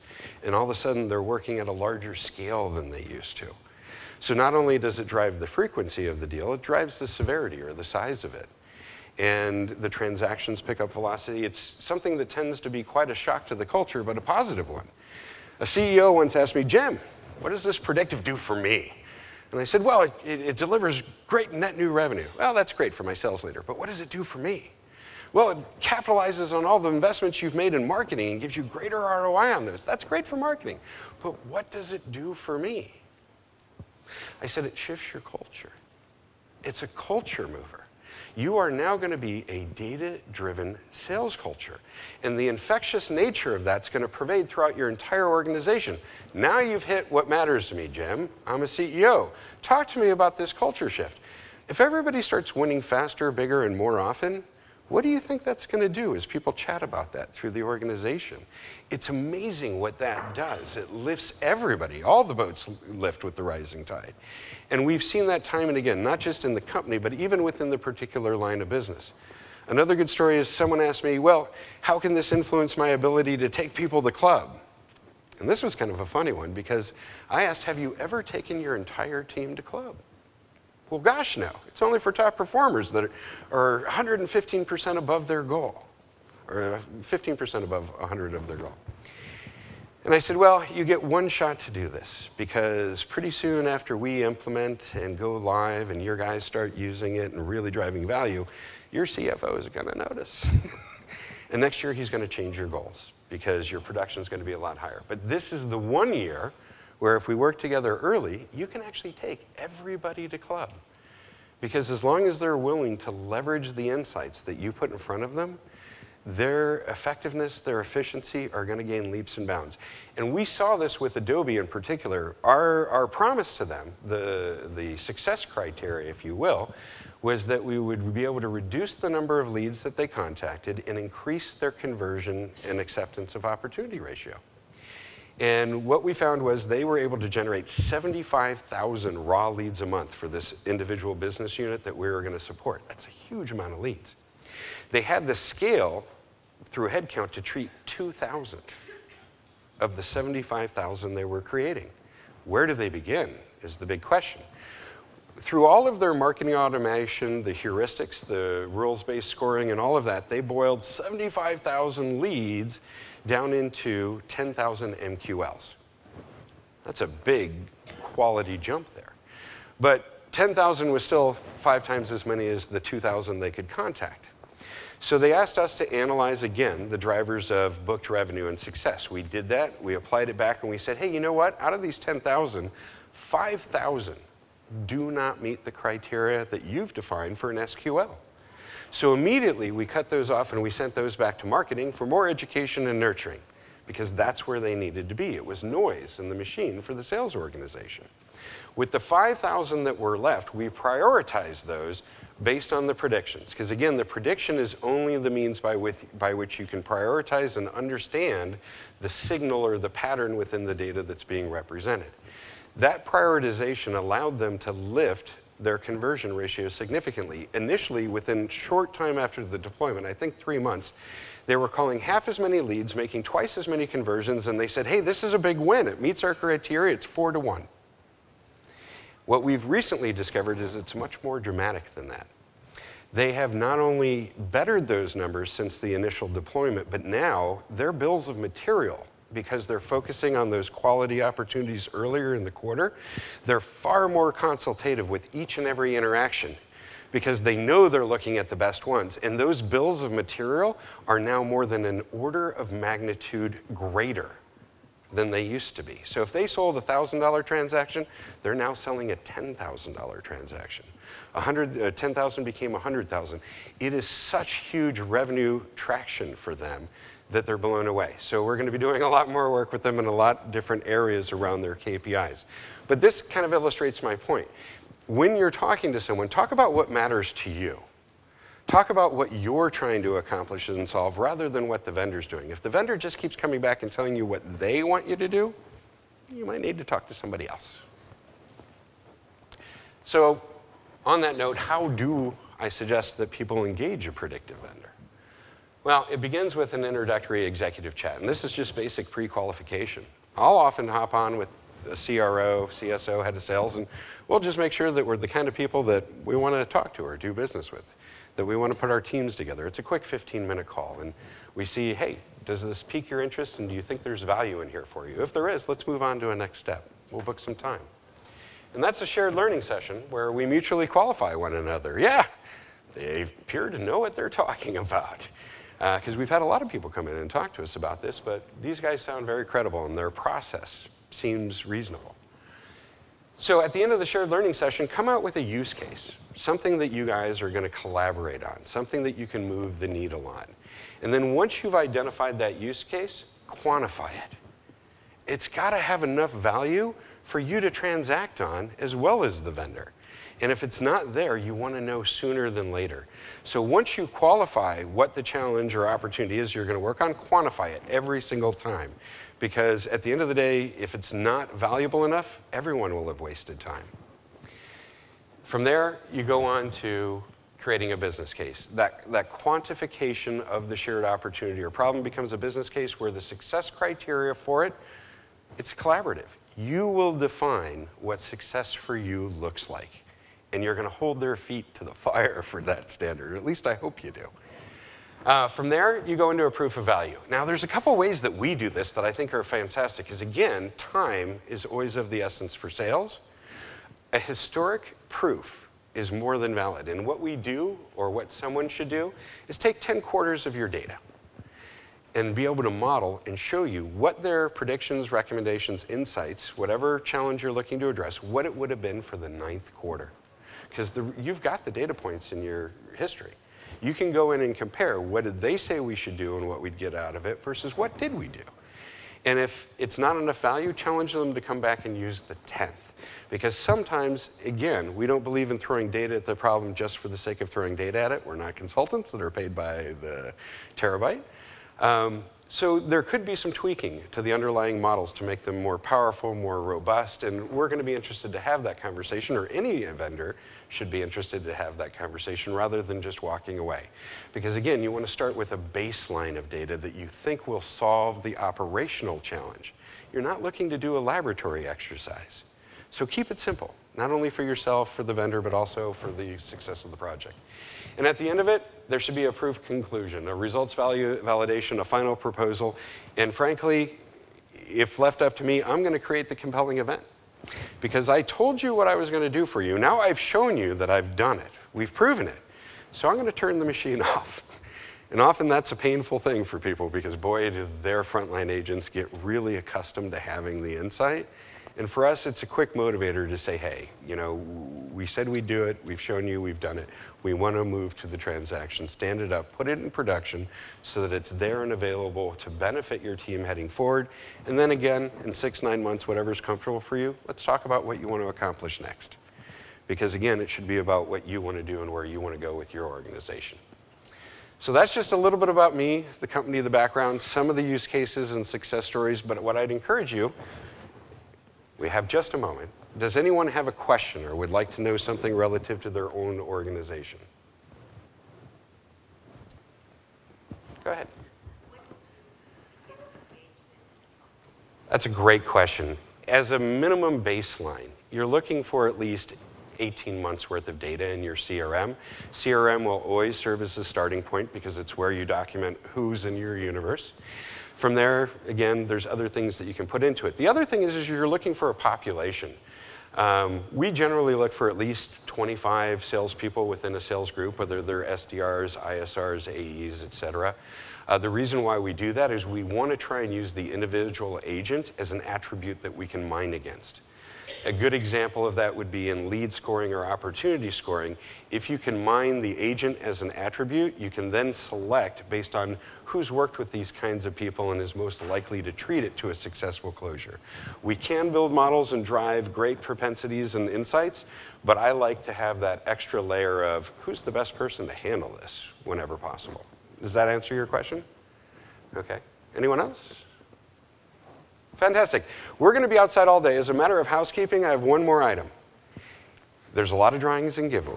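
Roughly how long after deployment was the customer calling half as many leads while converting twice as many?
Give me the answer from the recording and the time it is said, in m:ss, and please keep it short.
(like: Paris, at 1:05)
3 months, at 3:40.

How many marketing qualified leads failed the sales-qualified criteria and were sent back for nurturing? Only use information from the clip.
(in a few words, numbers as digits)
5,000.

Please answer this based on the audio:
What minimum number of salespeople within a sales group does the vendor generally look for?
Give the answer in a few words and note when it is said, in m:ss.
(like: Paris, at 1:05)
25, at 9:05.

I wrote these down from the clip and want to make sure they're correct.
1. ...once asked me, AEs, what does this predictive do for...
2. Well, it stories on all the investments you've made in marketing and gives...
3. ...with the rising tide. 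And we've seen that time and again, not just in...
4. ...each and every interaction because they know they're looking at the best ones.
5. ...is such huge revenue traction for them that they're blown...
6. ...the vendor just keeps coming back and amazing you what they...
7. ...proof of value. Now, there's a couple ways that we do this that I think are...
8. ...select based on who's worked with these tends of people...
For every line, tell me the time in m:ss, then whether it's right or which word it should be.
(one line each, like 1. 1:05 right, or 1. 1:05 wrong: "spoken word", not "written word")
1. 0:16 wrong: "Jim", not "AEs"
2. 0:25 wrong: "capitalizes", not "stories"
3. 1:03 right
4. 4:05 right
5. 4:23 right
6. 4:42 wrong: "telling", not "amazing"
7. 6:26 right
8. 9:24 wrong: "kinds", not "tends".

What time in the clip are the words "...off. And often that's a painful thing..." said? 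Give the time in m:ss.
7:54.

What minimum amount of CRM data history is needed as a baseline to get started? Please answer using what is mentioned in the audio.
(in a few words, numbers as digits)
18 months.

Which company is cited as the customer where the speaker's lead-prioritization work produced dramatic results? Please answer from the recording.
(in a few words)
Adobe.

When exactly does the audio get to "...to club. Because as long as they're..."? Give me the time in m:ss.
1:50.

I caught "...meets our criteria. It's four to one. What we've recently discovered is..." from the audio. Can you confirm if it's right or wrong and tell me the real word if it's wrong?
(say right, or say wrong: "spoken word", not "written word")
right.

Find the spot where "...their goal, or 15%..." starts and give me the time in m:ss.
1:25.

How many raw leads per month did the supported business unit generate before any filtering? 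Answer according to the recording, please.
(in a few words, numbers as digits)
75,000.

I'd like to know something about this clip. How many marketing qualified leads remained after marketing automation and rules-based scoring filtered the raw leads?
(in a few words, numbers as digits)
10,000.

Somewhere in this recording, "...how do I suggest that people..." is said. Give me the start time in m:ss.
4:51.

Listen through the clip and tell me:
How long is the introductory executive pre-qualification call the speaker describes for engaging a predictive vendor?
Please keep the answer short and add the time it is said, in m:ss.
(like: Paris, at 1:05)
15 minutes, at 5:10.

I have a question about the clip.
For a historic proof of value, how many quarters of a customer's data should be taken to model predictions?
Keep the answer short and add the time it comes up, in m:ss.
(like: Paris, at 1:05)
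10 quarters, at 6:39.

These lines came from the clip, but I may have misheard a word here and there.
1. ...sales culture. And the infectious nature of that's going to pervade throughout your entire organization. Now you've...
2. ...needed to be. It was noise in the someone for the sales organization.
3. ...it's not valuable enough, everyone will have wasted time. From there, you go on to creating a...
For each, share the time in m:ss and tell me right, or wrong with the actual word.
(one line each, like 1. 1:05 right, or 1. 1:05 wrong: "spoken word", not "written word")
1. 0:40 right
2. 3:14 wrong: "machine", not "someone"
3. 6:00 right.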